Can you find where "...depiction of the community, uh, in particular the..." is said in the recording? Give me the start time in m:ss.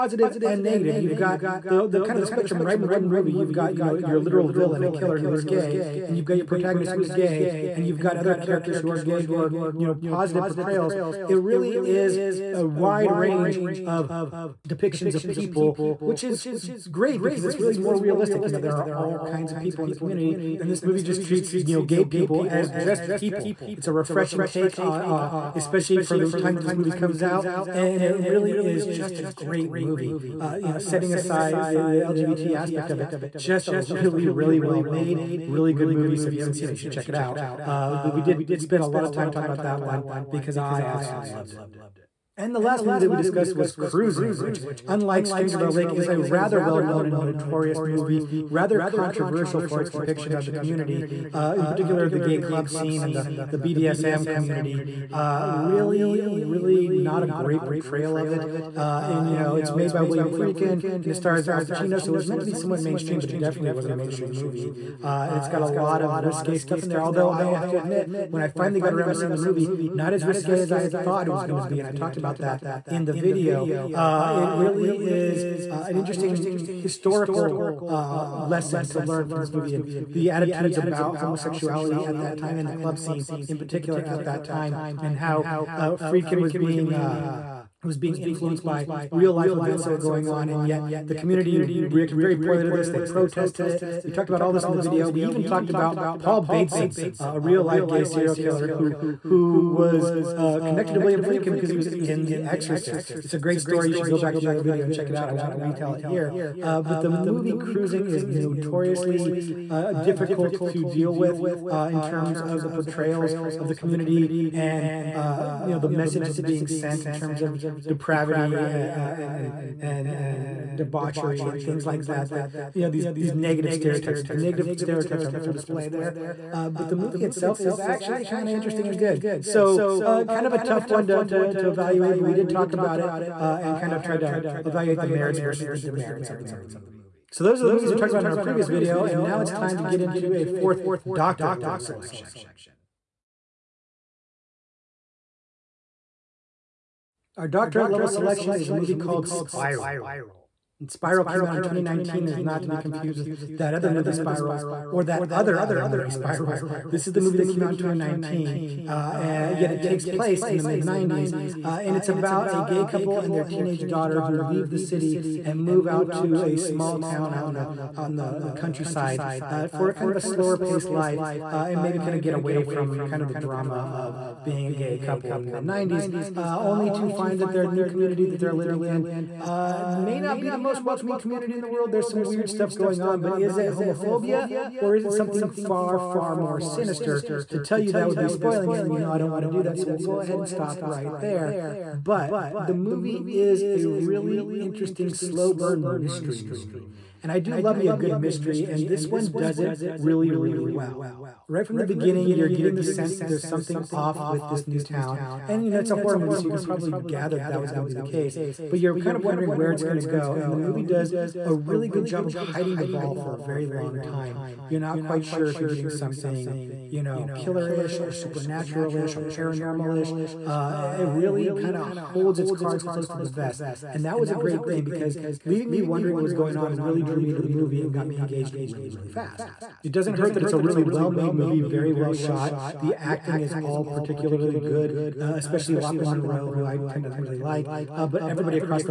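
0:49.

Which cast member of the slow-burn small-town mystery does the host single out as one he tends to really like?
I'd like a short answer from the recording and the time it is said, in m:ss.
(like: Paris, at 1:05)
Lochlyn Munro, at 3:55.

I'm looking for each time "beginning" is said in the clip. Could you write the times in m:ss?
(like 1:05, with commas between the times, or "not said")
3:21.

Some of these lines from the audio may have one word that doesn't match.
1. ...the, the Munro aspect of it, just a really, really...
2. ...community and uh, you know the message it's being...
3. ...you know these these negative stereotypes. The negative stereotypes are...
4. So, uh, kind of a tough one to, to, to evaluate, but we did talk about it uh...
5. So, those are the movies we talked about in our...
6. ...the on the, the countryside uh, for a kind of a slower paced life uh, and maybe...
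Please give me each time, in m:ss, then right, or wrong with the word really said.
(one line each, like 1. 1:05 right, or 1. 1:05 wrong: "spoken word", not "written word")
1. 0:31 wrong: "LGBT", not "Munro"
2. 1:53 right
3. 2:02 right
4. 2:09 right
5. 2:17 right
6. 2:47 right.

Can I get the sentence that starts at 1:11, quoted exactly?
And I talked about about that in the video.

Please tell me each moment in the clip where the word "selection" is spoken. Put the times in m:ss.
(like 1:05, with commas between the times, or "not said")
2:21, 2:28.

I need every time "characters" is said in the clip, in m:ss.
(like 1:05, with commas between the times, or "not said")
0:08.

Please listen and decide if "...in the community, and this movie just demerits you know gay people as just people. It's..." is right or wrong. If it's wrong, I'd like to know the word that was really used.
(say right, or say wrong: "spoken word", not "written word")
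wrong: "treats", not "demerits".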